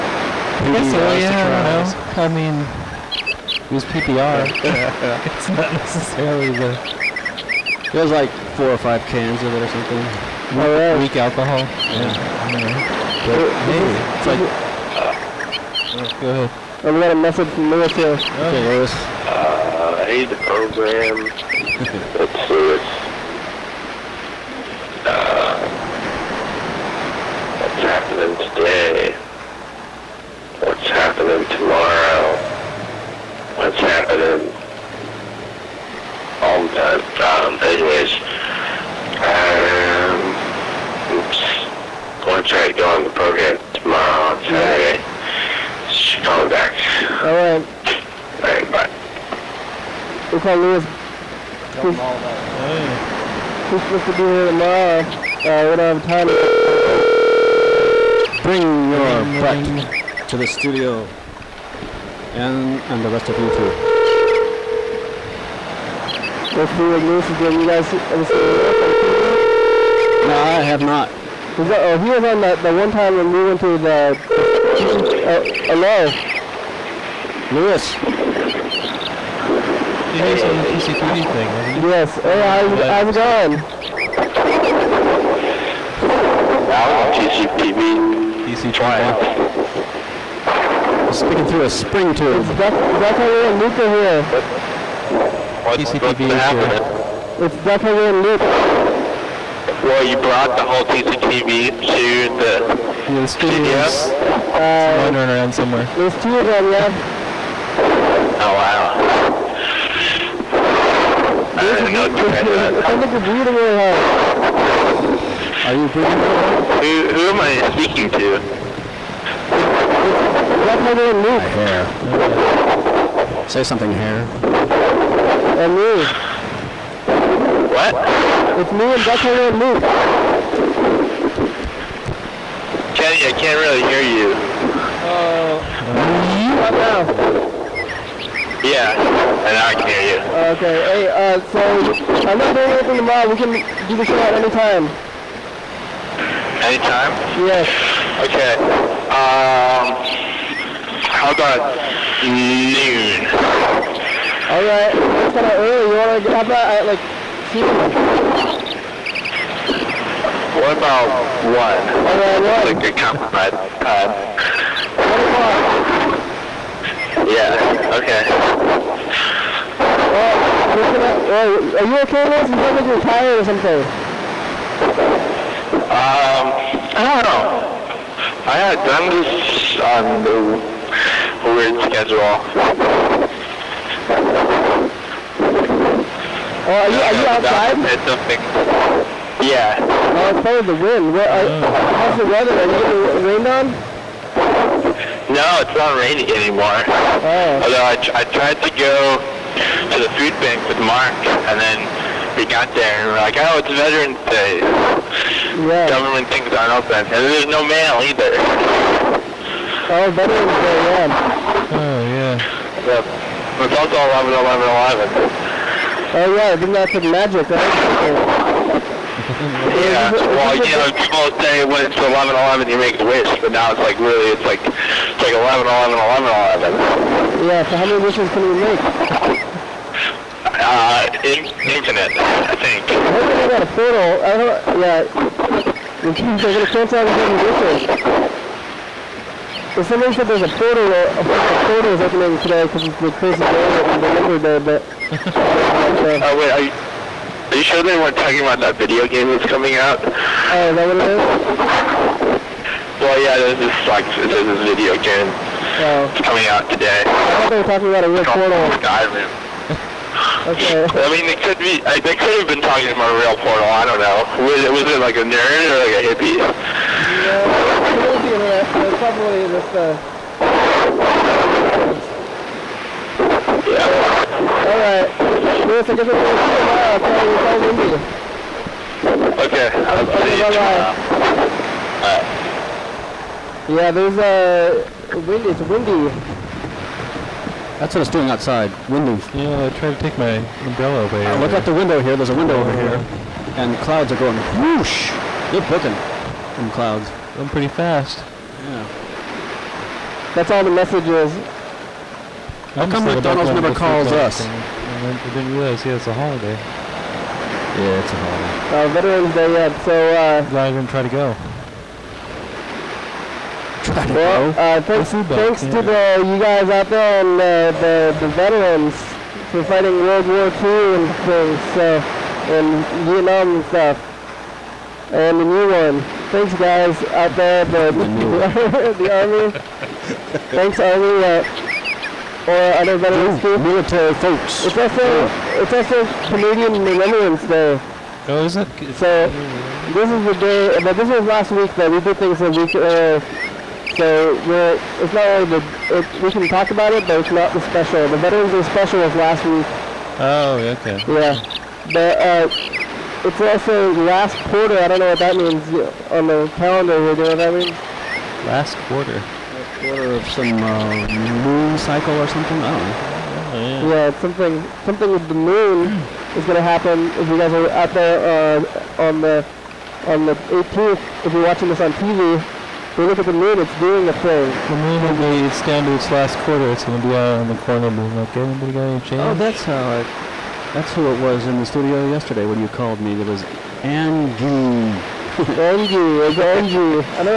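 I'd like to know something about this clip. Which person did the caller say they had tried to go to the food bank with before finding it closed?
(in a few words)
Mark.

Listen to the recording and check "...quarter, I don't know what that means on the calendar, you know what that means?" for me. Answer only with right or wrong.
right.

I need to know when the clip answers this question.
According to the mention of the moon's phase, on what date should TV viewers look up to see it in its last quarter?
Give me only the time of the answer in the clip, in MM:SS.
06:10.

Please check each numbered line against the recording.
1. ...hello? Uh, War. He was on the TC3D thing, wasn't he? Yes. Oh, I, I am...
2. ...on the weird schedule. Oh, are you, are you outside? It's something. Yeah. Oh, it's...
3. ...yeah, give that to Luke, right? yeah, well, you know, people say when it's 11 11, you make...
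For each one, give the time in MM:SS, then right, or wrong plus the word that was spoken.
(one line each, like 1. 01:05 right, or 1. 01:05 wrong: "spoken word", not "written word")
1. 01:15 wrong: "Lewis", not "War"
2. 02:59 right
3. 03:36 wrong: "Magic", not "Luke".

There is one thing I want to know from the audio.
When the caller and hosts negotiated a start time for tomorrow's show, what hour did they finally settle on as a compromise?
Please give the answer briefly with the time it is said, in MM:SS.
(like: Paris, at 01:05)
1 o'clock, at 02:45.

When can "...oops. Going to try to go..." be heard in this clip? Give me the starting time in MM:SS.
00:41.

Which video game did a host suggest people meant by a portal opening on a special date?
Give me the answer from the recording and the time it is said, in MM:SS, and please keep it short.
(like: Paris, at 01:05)
Skyrim, at 04:18.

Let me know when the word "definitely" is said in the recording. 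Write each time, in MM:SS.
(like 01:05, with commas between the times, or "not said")
01:37, 02:00.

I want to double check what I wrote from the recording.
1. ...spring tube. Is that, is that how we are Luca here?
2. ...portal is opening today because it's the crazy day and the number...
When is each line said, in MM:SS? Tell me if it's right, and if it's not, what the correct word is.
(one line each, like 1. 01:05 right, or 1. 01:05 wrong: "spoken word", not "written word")
1. 01:31 right
2. 04:01 right.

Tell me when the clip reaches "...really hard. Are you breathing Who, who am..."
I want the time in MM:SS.
01:53.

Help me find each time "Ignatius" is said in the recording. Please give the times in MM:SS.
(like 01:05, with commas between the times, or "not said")
01:06.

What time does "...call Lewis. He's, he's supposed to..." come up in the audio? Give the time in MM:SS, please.
00:50.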